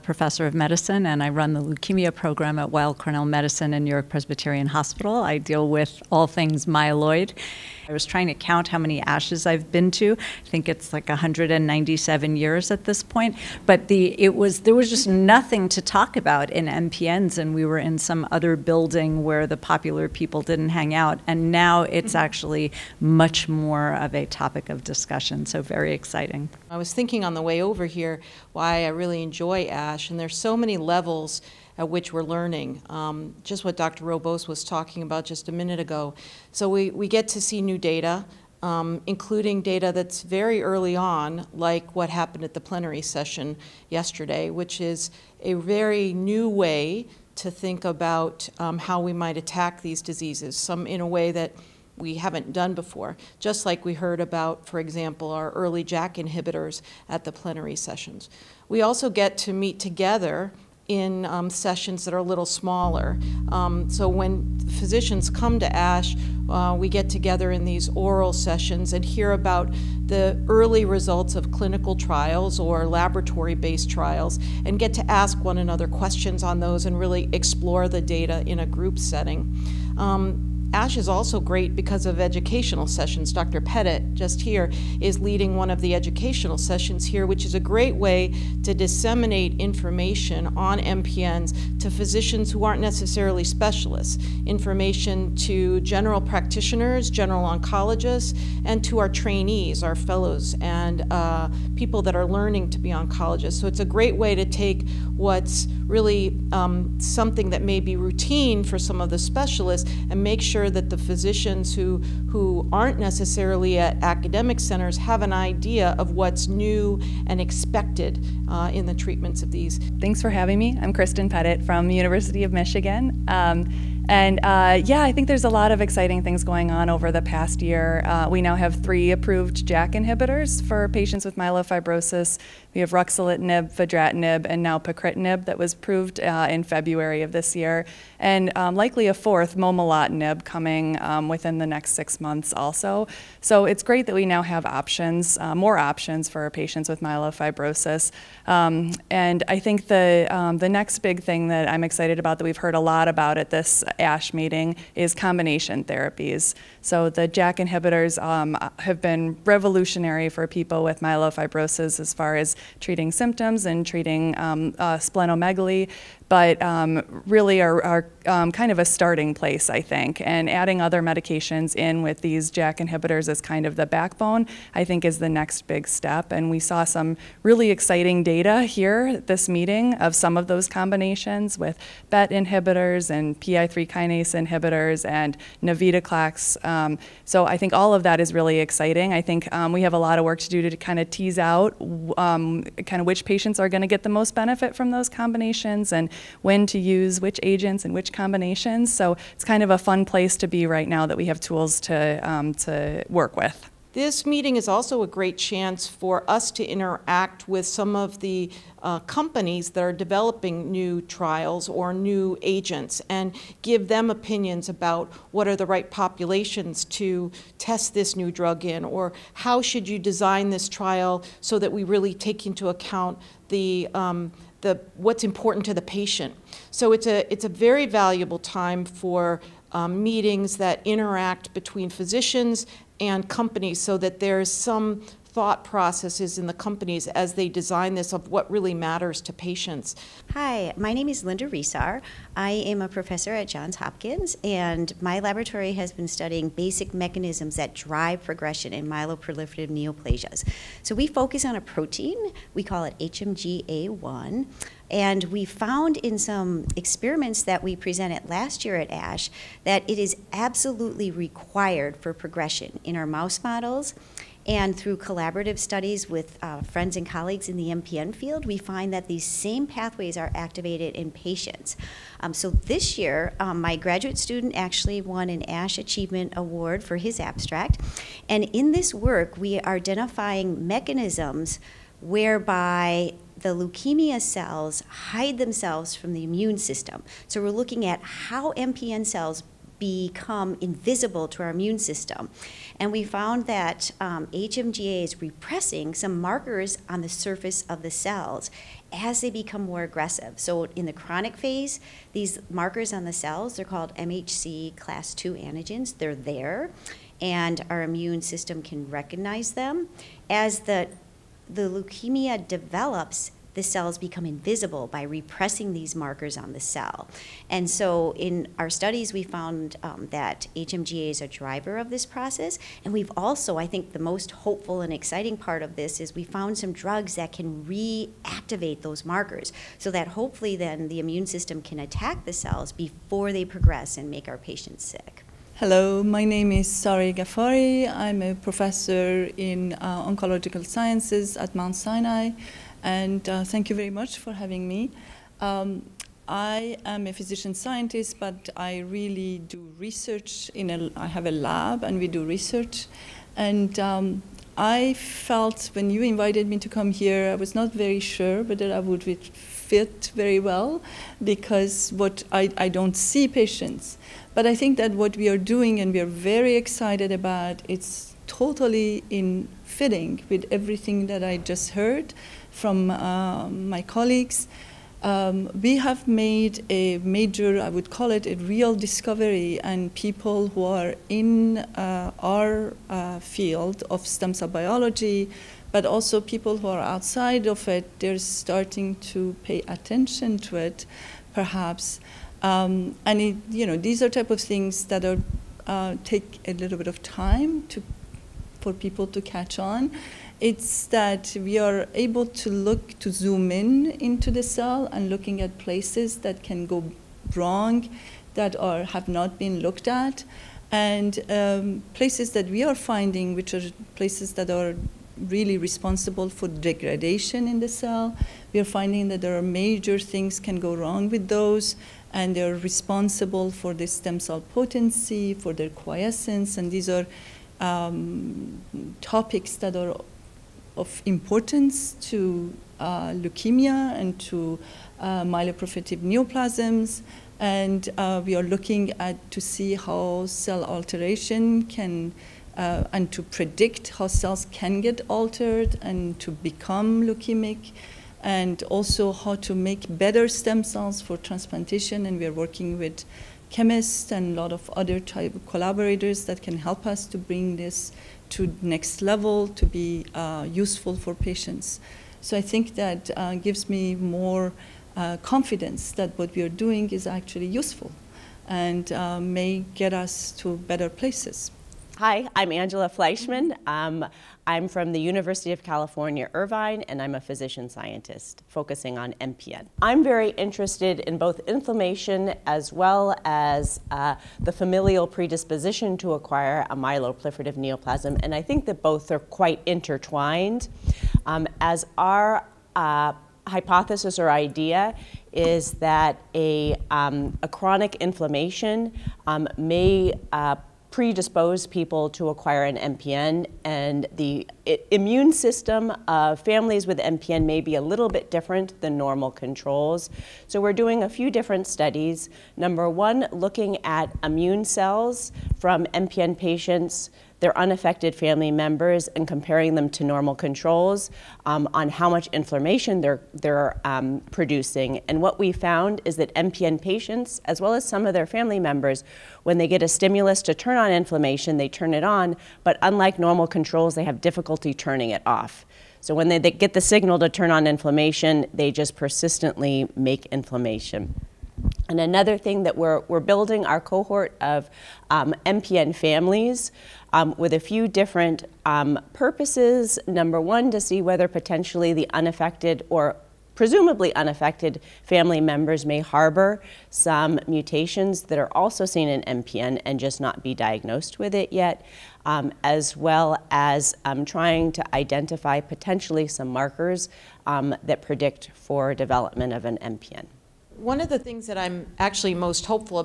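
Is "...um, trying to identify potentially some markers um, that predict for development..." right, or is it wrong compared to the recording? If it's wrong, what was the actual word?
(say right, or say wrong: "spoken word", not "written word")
right.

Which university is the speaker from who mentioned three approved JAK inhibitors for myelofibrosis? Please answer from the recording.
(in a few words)
University of Michigan.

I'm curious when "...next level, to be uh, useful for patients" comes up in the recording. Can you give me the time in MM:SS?
07:38.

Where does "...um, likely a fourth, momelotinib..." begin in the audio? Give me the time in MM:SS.
02:18.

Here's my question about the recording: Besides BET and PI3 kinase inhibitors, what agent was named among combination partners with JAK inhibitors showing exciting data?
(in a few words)
Navitoclax.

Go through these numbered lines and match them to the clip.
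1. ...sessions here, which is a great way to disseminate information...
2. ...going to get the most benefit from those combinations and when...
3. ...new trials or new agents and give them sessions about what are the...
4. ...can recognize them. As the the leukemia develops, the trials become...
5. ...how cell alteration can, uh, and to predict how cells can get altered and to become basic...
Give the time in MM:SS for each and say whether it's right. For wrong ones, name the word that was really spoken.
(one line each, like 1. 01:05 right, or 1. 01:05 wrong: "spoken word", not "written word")
1. 01:26 right
2. 03:13 right
3. 03:30 wrong: "opinions", not "sessions"
4. 05:08 wrong: "cells", not "trials"
5. 07:19 wrong: "leukemic", not "basic".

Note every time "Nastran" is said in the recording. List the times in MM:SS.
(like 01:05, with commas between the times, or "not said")
not said.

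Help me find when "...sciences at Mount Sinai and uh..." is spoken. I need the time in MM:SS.
05:40.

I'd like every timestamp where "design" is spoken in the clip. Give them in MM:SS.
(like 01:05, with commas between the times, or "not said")
03:39, 03:57.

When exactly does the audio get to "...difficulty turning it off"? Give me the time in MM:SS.
08:54.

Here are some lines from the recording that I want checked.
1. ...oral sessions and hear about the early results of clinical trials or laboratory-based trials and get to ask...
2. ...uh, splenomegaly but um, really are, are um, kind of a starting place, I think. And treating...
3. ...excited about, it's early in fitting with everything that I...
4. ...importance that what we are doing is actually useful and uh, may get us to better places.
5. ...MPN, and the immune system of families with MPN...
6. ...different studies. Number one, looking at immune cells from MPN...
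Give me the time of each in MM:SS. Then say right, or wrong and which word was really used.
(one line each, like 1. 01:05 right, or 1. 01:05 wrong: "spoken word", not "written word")
1. 01:07 right
2. 02:44 wrong: "adding", not "treating"
3. 06:06 wrong: "totally", not "early"
4. 07:45 wrong: "confidence", not "importance"
5. 08:22 right
6. 08:31 right.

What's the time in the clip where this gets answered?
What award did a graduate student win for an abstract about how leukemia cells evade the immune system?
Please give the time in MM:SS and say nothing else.
04:35.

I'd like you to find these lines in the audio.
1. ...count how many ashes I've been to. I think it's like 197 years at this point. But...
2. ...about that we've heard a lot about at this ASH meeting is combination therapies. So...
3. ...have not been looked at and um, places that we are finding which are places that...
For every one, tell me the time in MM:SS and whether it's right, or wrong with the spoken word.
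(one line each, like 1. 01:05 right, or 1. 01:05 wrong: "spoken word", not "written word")
1. 00:08 right
2. 02:32 right
3. 06:48 right.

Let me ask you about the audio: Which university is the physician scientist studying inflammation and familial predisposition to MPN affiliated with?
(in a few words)
University of California, Irvine.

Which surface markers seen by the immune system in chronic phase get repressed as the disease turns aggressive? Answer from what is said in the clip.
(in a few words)
MHC class 2 antigens.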